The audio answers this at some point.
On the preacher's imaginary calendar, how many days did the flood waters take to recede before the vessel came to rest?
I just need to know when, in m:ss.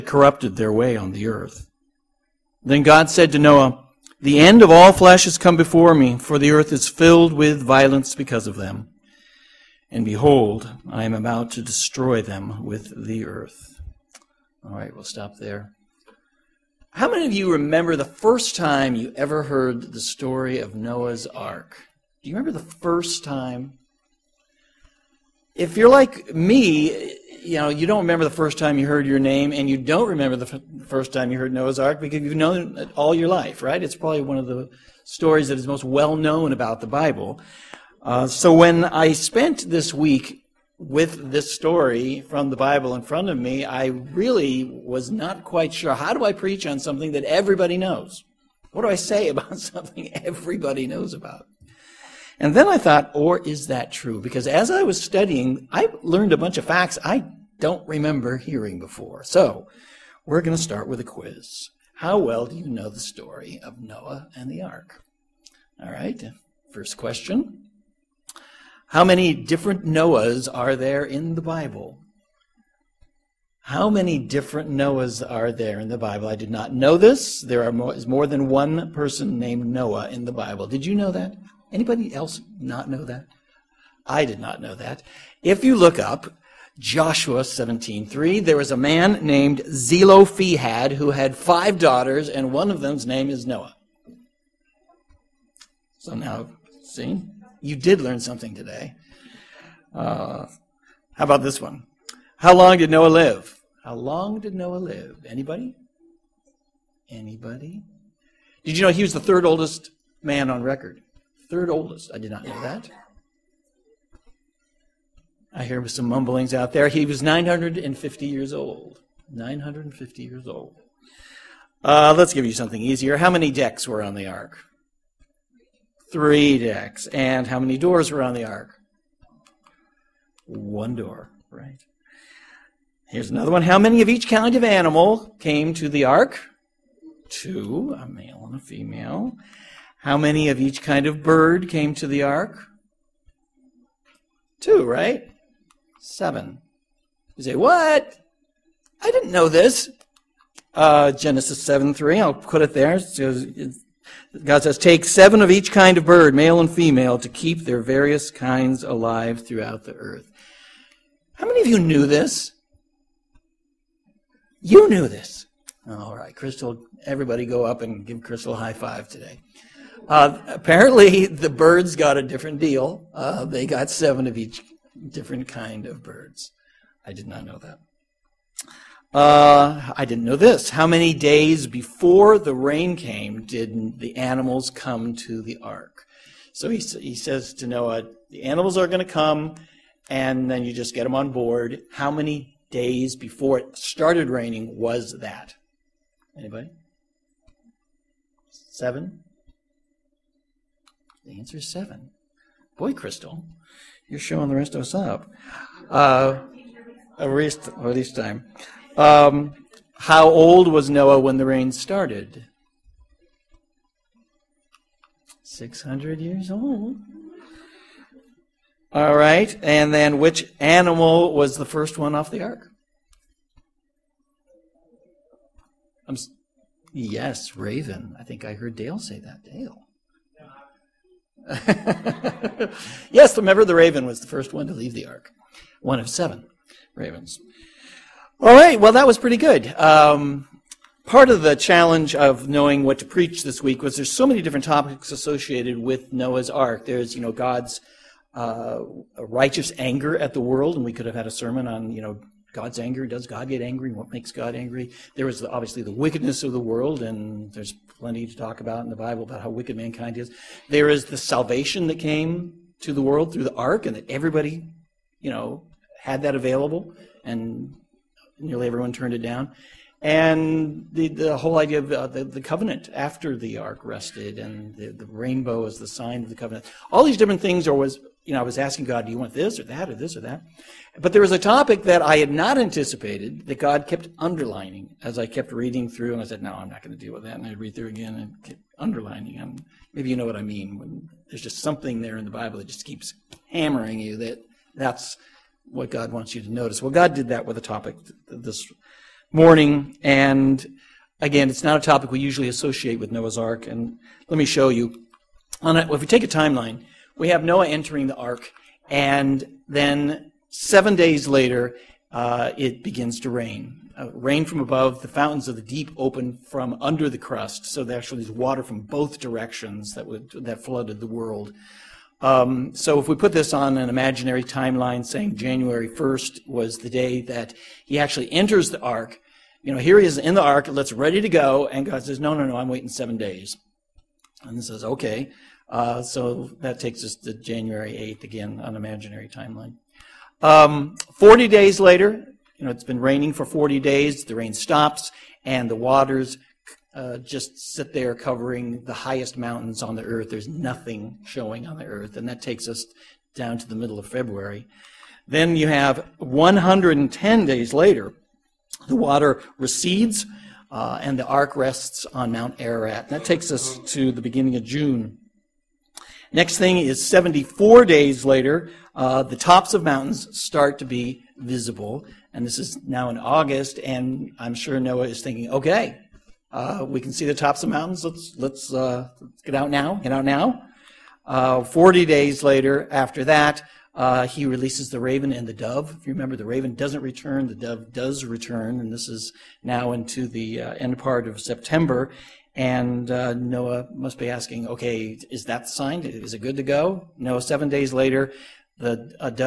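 5:56.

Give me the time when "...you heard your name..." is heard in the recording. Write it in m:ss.
0:28.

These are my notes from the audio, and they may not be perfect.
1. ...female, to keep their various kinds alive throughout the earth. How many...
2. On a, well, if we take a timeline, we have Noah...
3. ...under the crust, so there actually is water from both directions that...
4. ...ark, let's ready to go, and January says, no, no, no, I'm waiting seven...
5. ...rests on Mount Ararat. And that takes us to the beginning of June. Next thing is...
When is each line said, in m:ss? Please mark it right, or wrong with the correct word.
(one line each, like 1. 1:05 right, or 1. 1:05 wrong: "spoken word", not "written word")
1. 2:36 right
2. 5:05 right
3. 5:16 right
4. 5:30 wrong: "God", not "January"
5. 6:01 right.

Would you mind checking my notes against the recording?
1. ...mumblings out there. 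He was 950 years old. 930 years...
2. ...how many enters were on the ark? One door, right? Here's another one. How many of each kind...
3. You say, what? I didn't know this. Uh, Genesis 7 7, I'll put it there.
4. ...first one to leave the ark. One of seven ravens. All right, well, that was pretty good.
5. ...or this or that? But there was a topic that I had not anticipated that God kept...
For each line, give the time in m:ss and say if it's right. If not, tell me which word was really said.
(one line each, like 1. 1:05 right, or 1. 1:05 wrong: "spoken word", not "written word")
1. 1:56 wrong: "950", not "930"
2. 2:07 wrong: "doors", not "enters"
3. 2:27 wrong: "3", not "7"
4. 3:54 right
5. 4:39 right.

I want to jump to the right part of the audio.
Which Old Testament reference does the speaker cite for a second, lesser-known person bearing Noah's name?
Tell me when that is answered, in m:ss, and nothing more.
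1:26.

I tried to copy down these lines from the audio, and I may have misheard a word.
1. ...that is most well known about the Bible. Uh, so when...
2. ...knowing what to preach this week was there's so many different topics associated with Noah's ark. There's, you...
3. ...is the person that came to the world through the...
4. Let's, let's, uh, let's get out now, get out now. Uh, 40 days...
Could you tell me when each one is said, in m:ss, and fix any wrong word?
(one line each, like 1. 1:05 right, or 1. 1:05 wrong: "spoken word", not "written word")
1. 0:35 right
2. 4:02 right
3. 4:20 wrong: "salvation", not "person"
4. 6:18 right.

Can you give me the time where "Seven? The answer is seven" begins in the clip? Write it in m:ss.
3:18.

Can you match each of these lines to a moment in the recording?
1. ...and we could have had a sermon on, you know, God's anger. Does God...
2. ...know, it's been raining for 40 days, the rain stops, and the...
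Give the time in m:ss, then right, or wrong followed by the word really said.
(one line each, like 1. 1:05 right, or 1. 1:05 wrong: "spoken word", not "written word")
1. 4:10 right
2. 5:42 right.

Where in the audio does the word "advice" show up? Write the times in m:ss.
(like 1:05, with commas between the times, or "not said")
not said.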